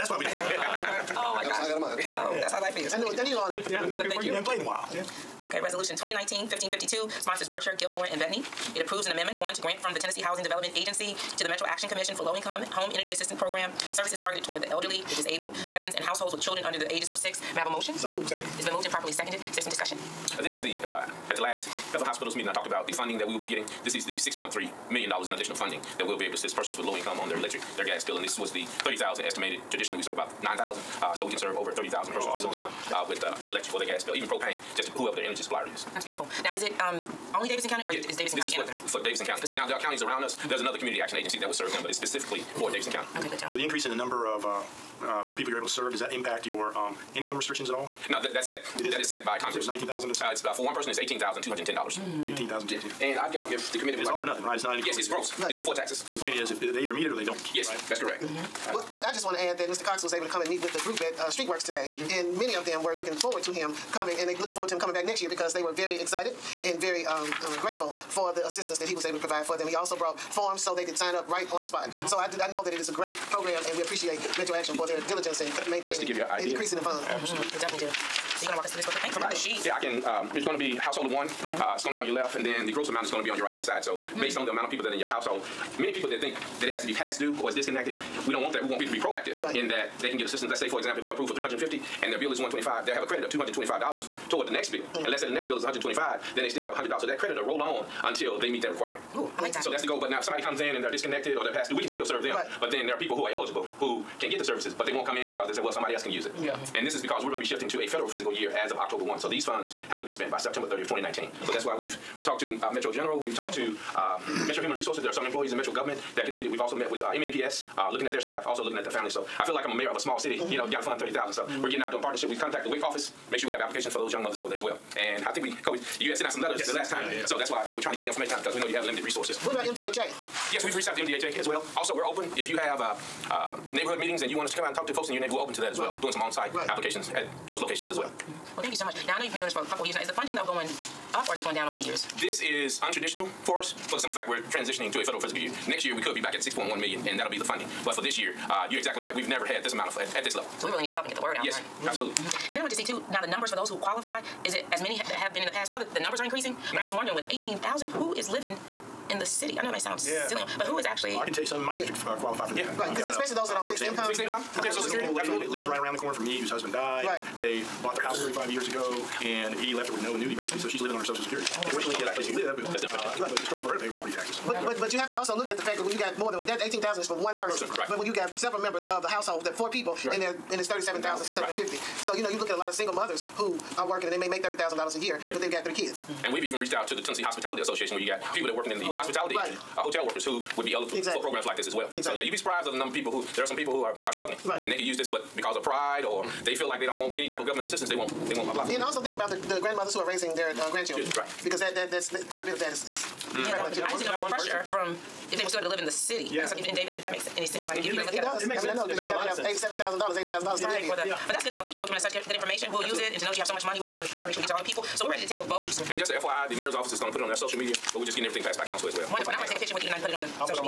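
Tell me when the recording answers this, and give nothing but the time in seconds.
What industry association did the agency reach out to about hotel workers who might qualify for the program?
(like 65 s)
187 s.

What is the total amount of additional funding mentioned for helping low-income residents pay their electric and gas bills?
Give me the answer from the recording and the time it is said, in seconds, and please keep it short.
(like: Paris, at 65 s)
$6.3 million, at 24 s.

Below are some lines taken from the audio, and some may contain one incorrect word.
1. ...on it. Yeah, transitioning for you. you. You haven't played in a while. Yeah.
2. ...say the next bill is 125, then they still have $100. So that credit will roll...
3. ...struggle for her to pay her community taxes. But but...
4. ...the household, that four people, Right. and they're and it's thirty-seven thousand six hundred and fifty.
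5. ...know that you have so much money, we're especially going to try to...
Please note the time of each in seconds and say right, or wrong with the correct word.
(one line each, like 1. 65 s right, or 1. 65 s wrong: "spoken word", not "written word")
1. 3 s wrong: "working", not "transitioning"
2. 95 s right
3. 173 s wrong: "property", not "community"
4. 179 s right
5. 213 s wrong: "definitely", not "especially".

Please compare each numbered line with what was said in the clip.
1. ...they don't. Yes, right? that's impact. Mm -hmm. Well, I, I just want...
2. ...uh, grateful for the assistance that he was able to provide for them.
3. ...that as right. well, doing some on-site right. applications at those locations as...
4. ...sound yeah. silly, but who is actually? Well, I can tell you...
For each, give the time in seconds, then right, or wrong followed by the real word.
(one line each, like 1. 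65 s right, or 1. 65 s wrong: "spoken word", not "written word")
1. 57 s wrong: "correct", not "impact"
2. 67 s right
3. 135 s right
4. 159 s right.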